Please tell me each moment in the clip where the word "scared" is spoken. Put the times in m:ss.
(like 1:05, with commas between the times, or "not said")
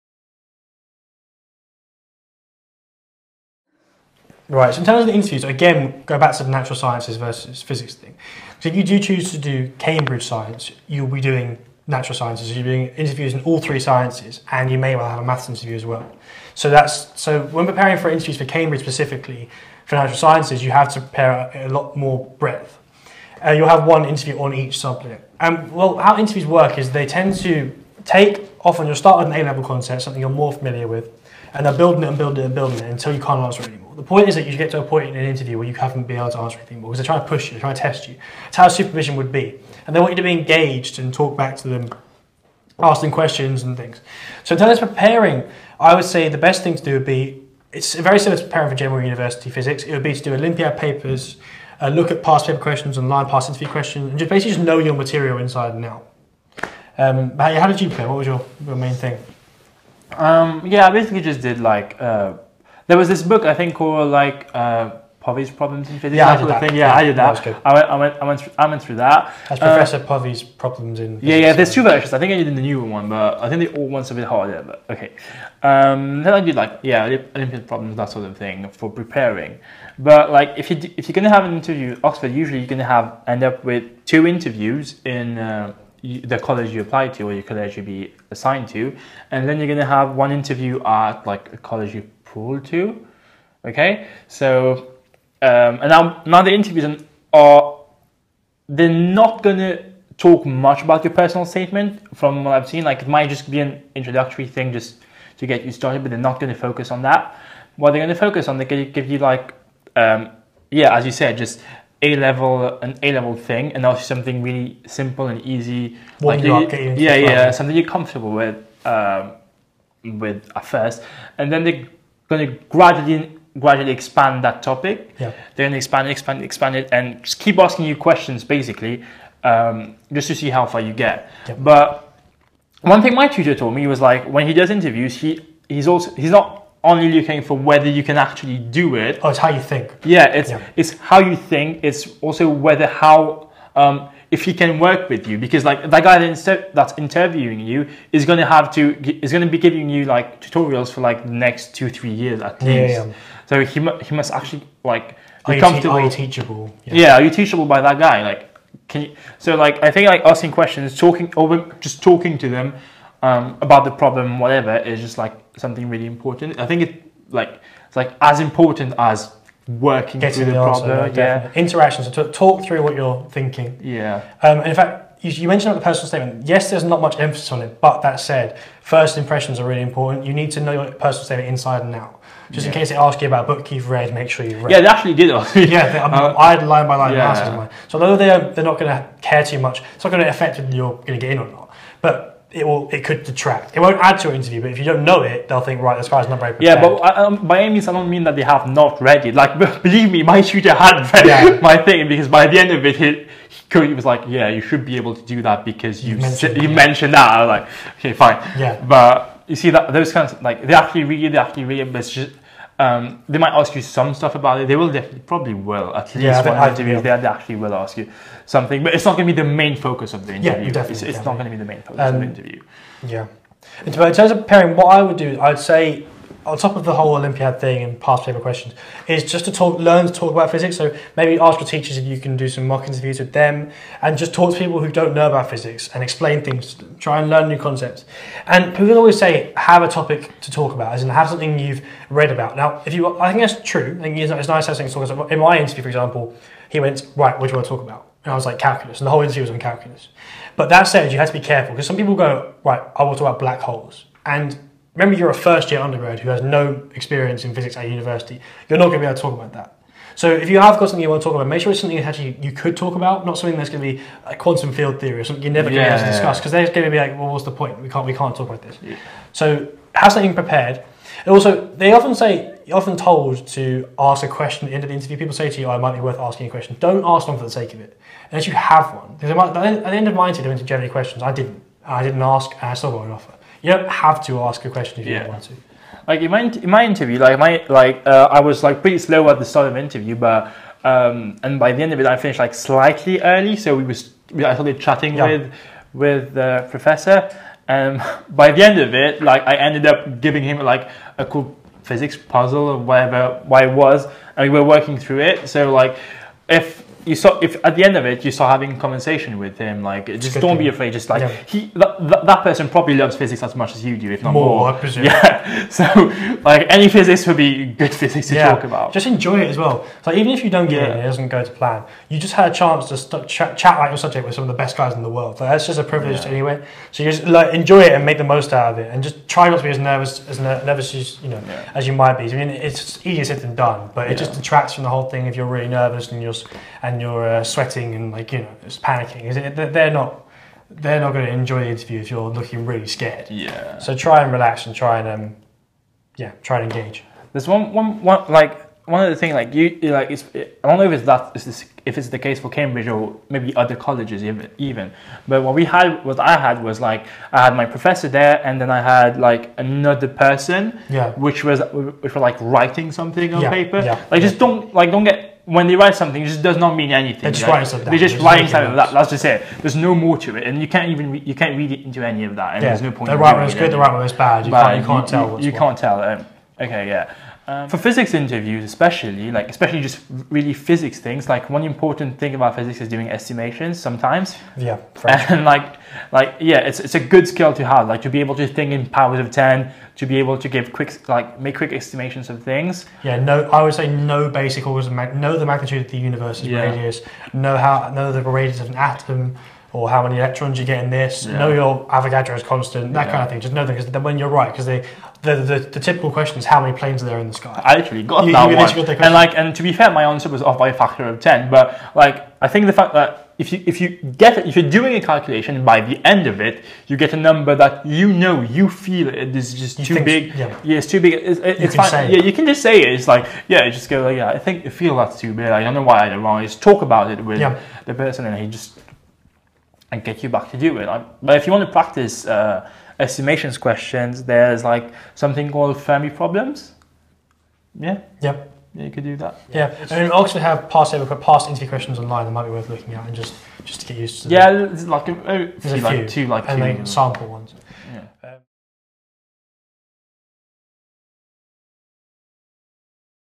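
5:42.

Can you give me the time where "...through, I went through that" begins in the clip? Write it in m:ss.
1:08.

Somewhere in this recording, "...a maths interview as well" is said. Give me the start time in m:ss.
0:15.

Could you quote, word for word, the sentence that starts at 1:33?
Okay, so um, and now now the interviews are they're not gonna talk much about your personal statement from what I've seen.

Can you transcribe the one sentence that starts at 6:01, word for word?
which was which were like writing something on yeah.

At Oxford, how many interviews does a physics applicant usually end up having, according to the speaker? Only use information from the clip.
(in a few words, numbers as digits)
2.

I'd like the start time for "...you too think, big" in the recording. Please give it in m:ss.
6:59.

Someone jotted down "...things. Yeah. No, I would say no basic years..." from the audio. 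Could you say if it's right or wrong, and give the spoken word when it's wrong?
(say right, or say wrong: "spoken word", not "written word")
wrong: "orders", not "years".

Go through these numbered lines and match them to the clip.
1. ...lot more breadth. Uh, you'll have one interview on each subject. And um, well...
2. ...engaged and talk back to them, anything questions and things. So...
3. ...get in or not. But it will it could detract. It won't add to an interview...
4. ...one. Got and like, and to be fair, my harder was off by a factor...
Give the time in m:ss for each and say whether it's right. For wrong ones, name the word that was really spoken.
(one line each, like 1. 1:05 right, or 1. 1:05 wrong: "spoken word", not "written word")
1. 0:21 right
2. 0:40 wrong: "asking", not "anything"
3. 3:11 right
4. 6:48 wrong: "answer", not "harder".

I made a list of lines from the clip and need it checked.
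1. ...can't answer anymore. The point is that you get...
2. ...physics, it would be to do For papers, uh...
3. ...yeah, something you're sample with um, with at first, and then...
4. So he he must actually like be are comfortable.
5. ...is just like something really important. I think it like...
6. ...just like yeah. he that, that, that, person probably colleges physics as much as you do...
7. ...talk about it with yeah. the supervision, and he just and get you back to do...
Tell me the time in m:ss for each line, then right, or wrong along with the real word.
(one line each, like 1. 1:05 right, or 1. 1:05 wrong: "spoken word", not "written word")
1. 0:33 right
2. 0:49 wrong: "Olympiad", not "For"
3. 1:57 wrong: "comfortable", not "sample"
4. 2:33 right
5. 2:44 right
6. 5:10 wrong: "loves", not "colleges"
7. 7:06 wrong: "person", not "supervision".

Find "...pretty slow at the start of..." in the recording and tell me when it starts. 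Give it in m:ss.
4:48.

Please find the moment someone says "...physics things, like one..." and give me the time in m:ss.
6:20.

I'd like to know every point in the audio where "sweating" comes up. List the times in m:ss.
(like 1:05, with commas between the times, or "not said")
5:37.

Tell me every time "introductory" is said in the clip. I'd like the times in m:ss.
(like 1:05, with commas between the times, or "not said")
1:43.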